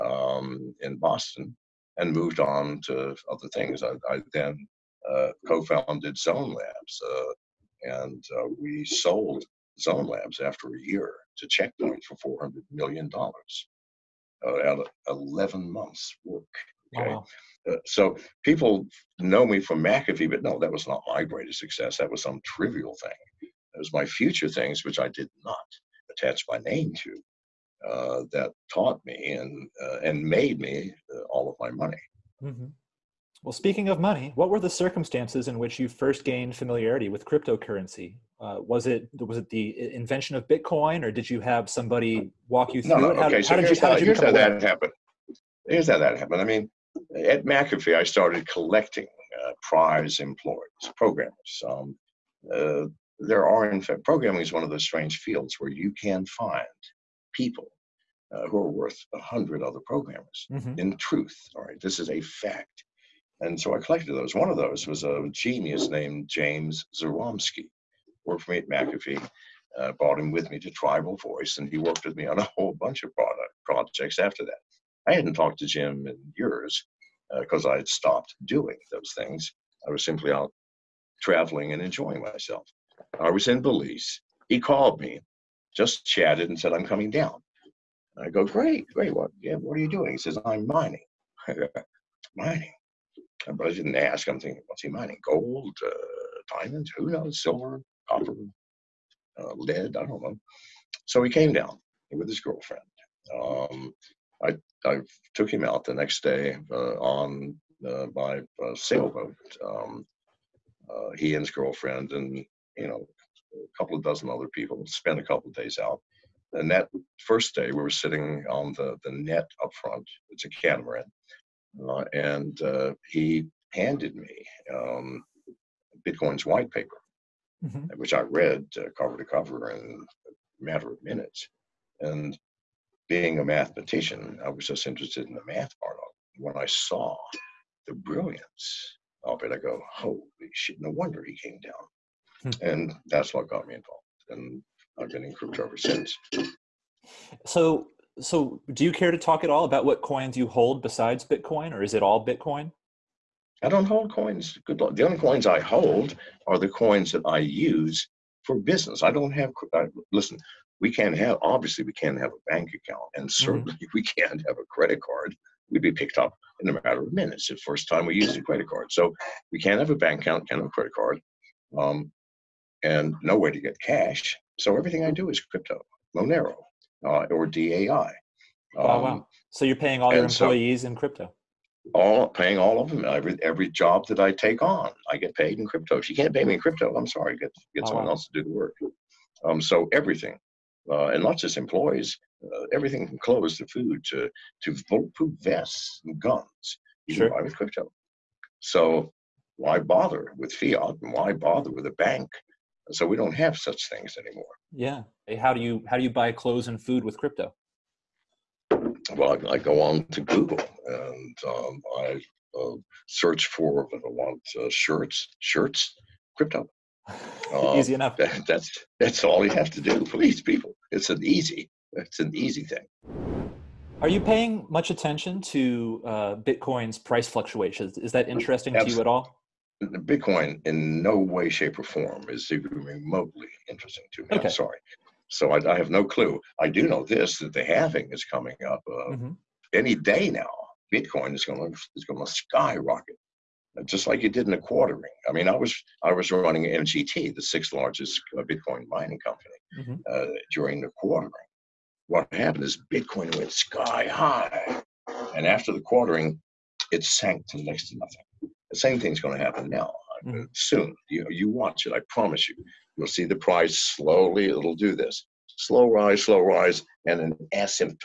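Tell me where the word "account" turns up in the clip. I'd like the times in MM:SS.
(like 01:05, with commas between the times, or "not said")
02:42, 02:50.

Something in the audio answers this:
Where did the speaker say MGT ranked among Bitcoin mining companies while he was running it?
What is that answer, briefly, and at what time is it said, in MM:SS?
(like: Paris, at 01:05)
Sixth largest, at 04:07.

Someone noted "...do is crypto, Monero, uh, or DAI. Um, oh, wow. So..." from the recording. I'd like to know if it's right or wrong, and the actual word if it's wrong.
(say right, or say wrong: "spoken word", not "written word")
right.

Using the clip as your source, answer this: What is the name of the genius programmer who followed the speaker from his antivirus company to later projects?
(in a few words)
James Zaromsky.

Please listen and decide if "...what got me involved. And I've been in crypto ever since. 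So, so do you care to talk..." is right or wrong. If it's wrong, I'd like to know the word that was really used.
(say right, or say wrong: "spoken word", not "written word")
right.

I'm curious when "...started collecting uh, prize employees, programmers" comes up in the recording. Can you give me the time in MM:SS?
00:48.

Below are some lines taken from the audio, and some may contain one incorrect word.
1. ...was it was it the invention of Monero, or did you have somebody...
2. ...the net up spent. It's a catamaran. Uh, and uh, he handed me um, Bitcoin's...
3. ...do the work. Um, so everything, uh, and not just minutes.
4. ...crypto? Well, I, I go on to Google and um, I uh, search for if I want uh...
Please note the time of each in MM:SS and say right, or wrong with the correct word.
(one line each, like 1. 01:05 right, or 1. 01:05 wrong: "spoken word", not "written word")
1. 00:38 wrong: "Bitcoin", not "Monero"
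2. 01:59 wrong: "front", not "spent"
3. 03:08 wrong: "employees", not "minutes"
4. 03:27 right.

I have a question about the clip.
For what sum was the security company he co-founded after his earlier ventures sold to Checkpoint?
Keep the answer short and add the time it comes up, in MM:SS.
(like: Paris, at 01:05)
$400 million, at 00:12.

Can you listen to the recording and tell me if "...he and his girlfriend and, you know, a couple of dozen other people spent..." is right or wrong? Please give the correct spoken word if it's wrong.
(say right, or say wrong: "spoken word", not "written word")
right.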